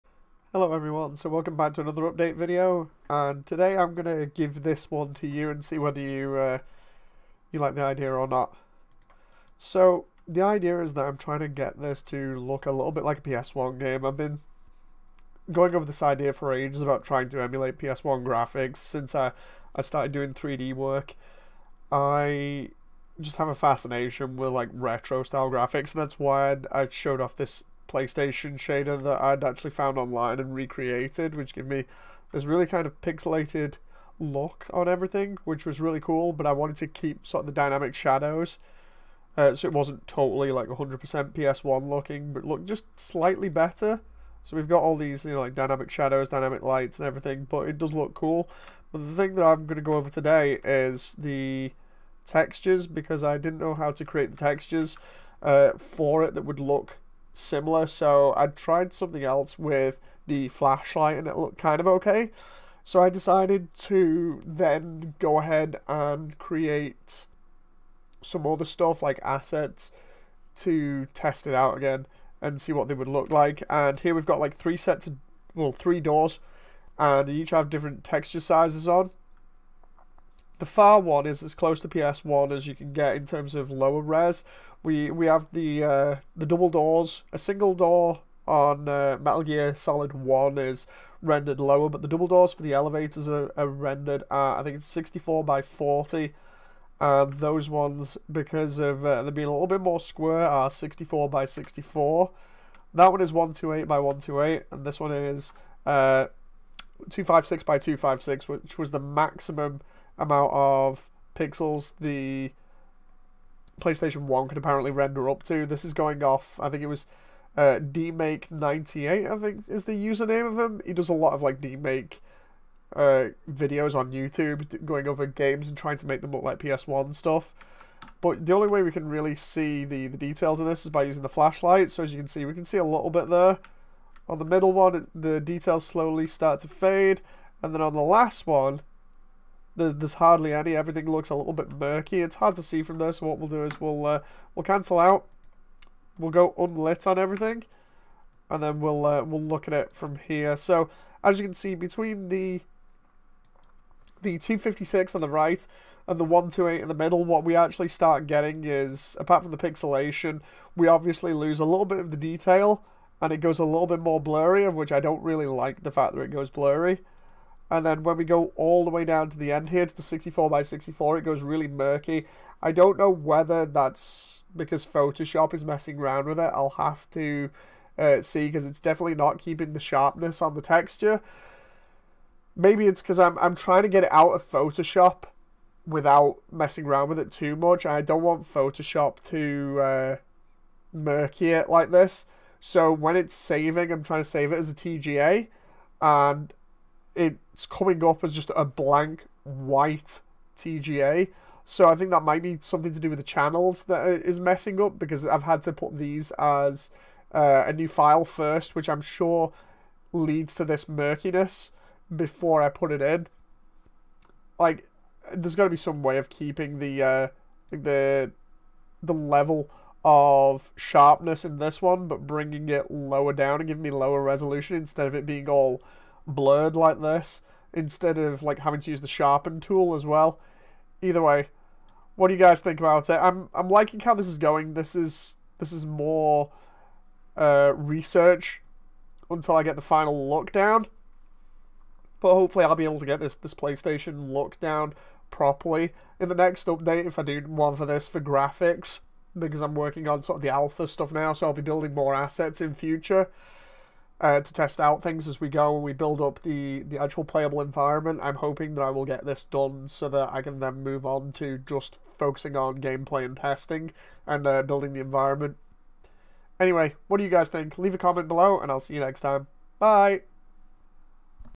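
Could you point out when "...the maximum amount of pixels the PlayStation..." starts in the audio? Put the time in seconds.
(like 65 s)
108 s.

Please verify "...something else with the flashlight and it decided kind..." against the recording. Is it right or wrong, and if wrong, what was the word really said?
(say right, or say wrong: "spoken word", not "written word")
wrong: "looked", not "decided".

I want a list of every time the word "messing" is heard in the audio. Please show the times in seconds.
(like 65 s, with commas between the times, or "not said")
175 s, 186 s, 204 s.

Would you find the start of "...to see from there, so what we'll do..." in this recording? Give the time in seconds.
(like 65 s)
142 s.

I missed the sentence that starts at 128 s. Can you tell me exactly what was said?
But the only way we can really see the, the details of this is by using the flashlight.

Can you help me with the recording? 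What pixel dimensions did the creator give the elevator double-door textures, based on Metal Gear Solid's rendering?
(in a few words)
64 by 40.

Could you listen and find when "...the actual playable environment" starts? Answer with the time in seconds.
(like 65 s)
256 s.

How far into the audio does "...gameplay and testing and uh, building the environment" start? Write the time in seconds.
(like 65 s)
262 s.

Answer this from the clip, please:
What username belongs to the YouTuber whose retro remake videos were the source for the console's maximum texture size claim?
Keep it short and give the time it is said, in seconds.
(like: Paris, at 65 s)
dmake98, at 117 s.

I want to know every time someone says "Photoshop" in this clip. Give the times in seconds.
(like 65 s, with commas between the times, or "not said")
174 s, 184 s, 188 s.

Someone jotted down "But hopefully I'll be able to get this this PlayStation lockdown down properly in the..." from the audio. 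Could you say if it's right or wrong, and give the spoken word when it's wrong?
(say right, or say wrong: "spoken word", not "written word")
right.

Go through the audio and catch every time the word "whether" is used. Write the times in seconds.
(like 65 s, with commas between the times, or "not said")
5 s, 173 s.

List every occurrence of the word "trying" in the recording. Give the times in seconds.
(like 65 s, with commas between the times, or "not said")
11 s, 17 s, 125 s, 183 s, 194 s.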